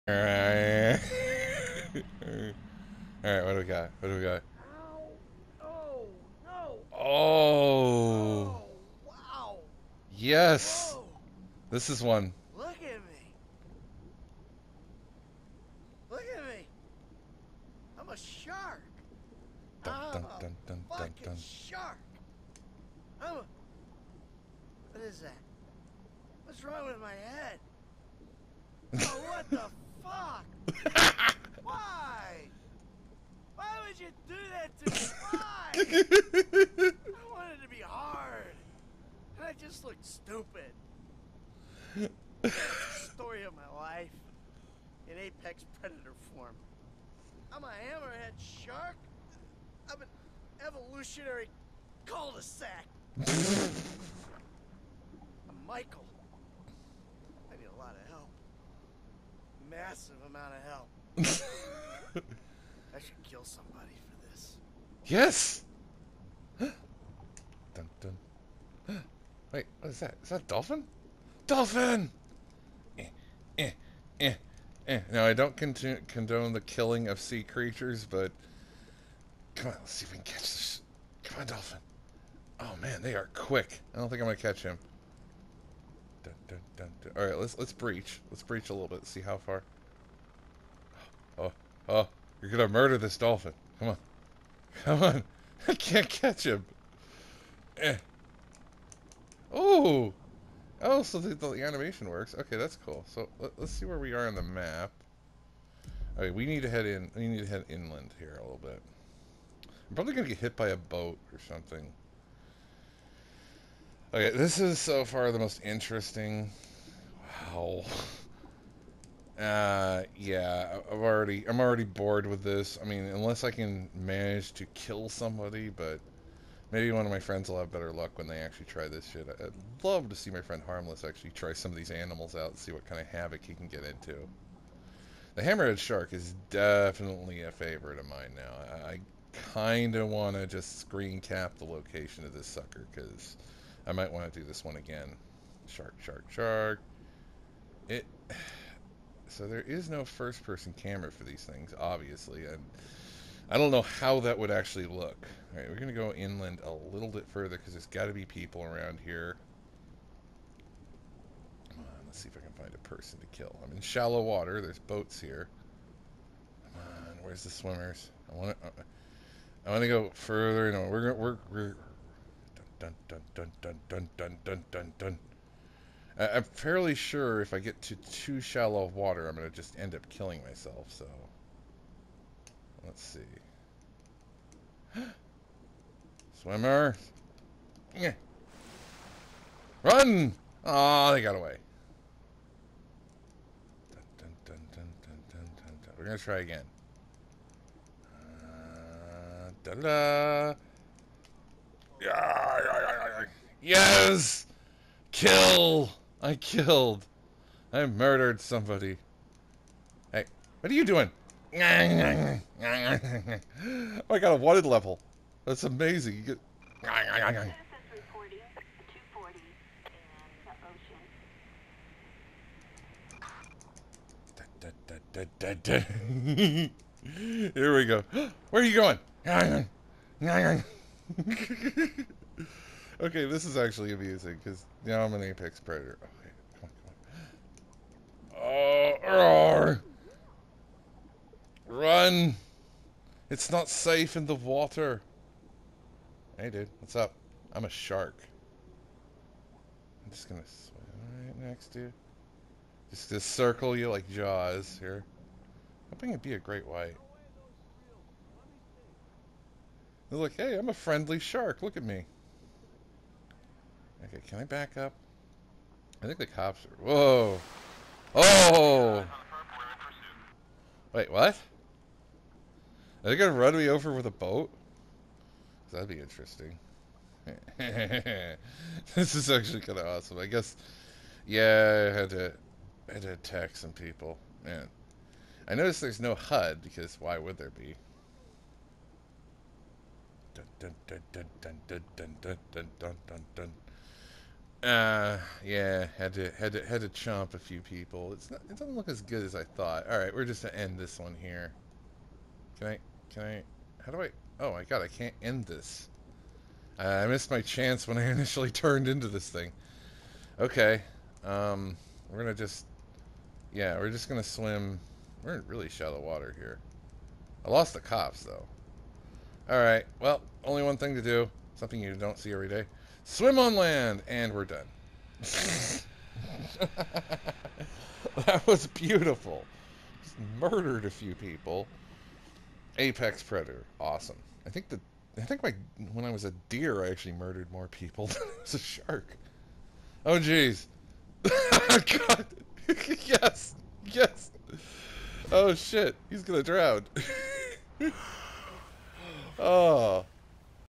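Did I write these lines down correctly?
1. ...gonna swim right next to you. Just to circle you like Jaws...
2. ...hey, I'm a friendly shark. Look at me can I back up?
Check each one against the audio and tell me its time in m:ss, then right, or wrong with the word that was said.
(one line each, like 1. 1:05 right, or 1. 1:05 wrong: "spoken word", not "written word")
1. 4:10 right
2. 4:20 right.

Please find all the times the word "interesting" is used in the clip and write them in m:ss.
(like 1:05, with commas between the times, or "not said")
1:55, 4:35.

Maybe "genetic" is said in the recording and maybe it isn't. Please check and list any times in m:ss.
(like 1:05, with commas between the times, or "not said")
not said.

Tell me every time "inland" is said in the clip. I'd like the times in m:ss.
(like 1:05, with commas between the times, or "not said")
1:47, 2:36.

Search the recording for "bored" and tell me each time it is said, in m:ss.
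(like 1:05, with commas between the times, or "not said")
2:01.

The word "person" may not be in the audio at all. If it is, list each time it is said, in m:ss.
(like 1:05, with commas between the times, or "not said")
2:30, 2:42.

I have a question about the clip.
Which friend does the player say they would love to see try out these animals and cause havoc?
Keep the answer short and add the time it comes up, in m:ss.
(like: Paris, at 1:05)
Harmless, at 2:10.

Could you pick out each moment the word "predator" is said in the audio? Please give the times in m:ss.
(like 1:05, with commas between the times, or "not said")
0:45, 3:55, 5:33.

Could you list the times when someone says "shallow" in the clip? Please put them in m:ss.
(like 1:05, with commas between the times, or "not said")
2:43, 2:58, 5:15.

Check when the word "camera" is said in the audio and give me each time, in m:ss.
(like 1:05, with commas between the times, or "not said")
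2:30.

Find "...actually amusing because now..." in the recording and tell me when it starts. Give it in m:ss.
3:53.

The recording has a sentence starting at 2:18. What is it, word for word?
I kind of want to just screen cap the location of this sucker, because I might want to do this one again.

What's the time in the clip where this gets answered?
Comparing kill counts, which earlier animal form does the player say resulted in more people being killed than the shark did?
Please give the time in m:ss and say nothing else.
5:36.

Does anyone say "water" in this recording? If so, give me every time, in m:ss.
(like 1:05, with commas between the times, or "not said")
2:44, 2:58, 4:04, 5:15.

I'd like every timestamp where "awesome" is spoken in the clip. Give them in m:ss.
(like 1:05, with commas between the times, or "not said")
4:39, 5:33.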